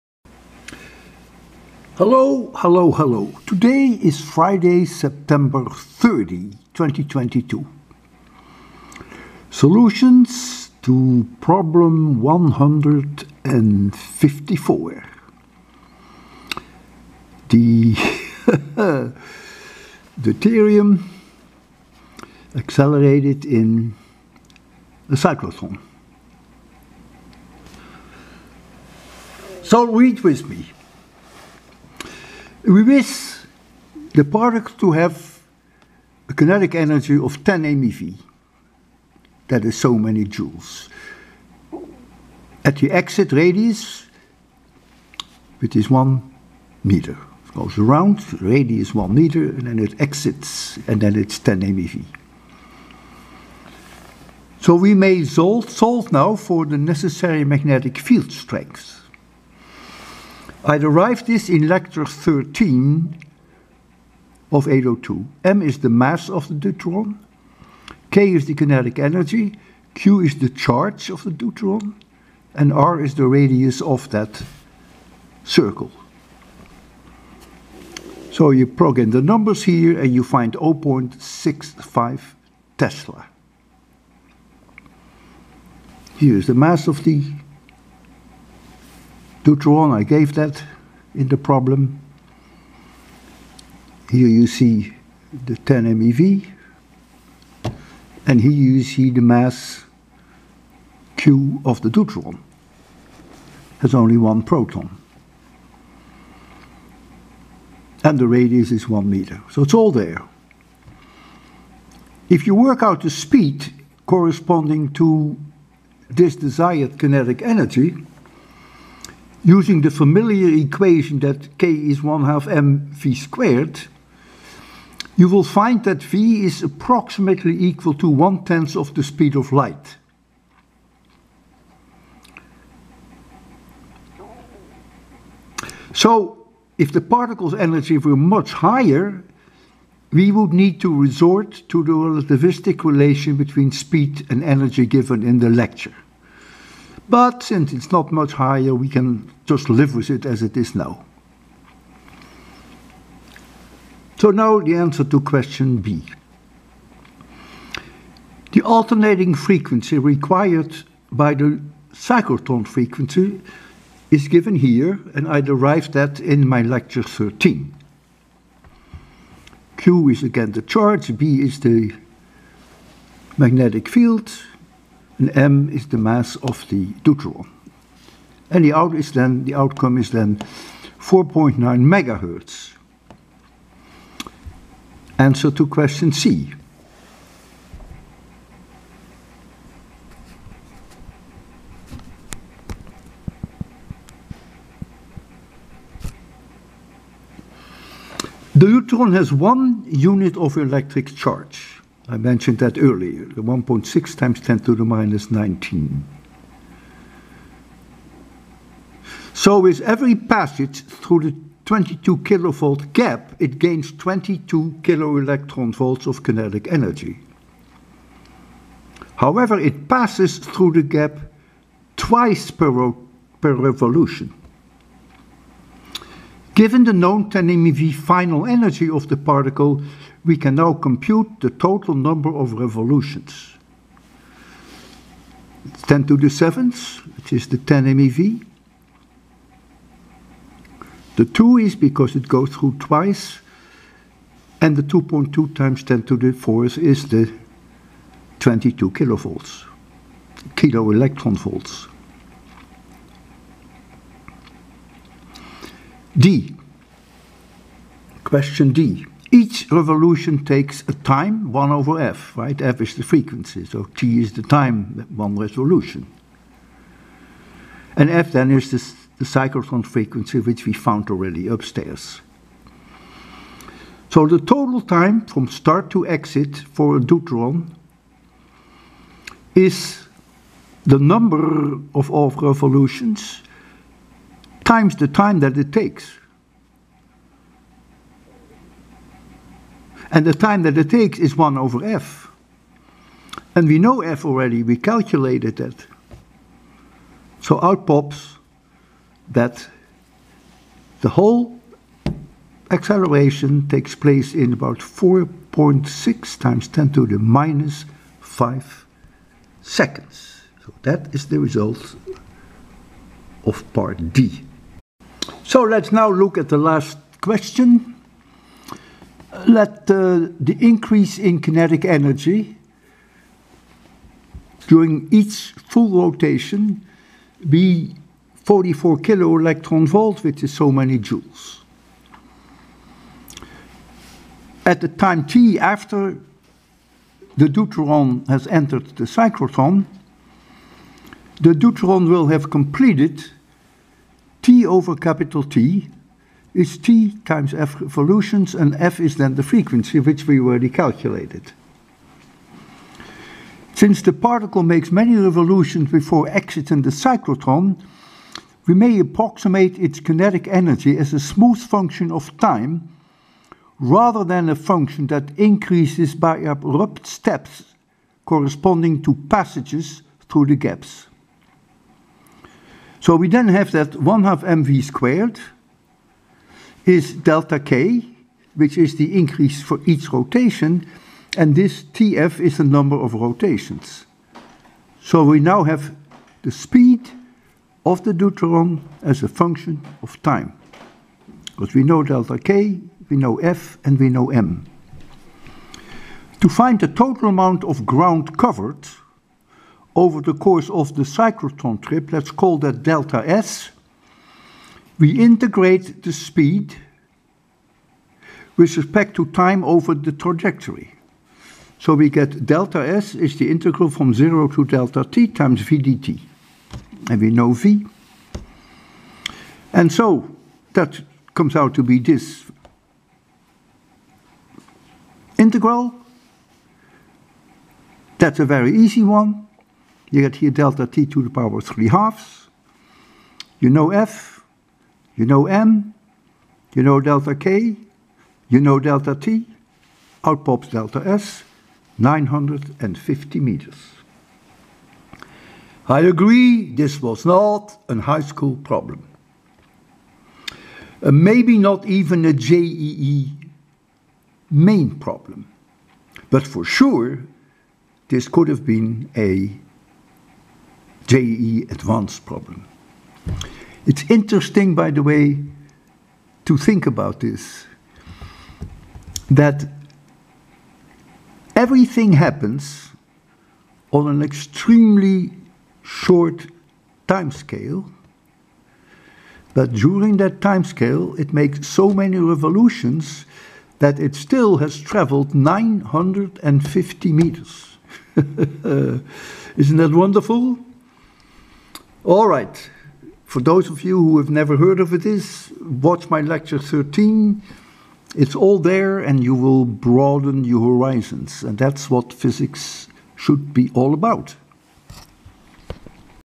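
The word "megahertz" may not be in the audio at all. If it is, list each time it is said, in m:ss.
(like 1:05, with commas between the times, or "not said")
3:01.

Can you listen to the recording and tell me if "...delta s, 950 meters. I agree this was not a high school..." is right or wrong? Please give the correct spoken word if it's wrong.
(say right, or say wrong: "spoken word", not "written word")
right.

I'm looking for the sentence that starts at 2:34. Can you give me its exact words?
So now the answer to question B.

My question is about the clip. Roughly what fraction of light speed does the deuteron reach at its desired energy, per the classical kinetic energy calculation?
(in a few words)
1/10.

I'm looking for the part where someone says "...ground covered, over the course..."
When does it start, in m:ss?
6:37.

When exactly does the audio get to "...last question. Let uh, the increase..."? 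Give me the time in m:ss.
5:16.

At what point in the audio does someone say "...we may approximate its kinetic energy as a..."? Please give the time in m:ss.
5:58.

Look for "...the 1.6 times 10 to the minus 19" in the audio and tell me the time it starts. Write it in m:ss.
3:23.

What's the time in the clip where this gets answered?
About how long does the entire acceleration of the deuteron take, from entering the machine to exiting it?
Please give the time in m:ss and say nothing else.
5:04.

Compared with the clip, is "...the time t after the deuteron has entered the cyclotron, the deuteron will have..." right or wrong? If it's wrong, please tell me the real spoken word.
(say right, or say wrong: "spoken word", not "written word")
right.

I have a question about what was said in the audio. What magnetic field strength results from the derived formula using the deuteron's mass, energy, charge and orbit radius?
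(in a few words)
0.65 Tesla.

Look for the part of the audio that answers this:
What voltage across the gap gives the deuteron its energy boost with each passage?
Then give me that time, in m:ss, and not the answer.
3:31.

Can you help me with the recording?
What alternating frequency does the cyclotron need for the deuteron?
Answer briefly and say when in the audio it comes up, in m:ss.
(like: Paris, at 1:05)
4.9 MHz, at 3:00.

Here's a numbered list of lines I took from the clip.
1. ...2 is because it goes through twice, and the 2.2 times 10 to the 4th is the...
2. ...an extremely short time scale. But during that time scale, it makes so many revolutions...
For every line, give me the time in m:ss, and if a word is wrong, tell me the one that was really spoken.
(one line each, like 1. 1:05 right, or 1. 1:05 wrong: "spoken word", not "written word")
1. 4:01 right
2. 7:54 right.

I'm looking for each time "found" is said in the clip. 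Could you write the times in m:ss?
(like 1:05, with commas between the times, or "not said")
4:30.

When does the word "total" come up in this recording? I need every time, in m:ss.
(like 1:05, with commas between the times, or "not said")
3:51, 4:34, 6:36.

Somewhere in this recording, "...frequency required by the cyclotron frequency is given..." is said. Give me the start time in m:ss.
2:39.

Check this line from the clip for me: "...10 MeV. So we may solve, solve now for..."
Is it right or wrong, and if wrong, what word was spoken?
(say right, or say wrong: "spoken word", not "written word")
right.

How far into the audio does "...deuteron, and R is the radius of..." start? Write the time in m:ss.
1:11.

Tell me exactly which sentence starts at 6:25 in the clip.
So we now have the speed of the deuteron as a function of time.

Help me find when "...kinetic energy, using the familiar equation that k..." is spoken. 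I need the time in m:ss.
1:56.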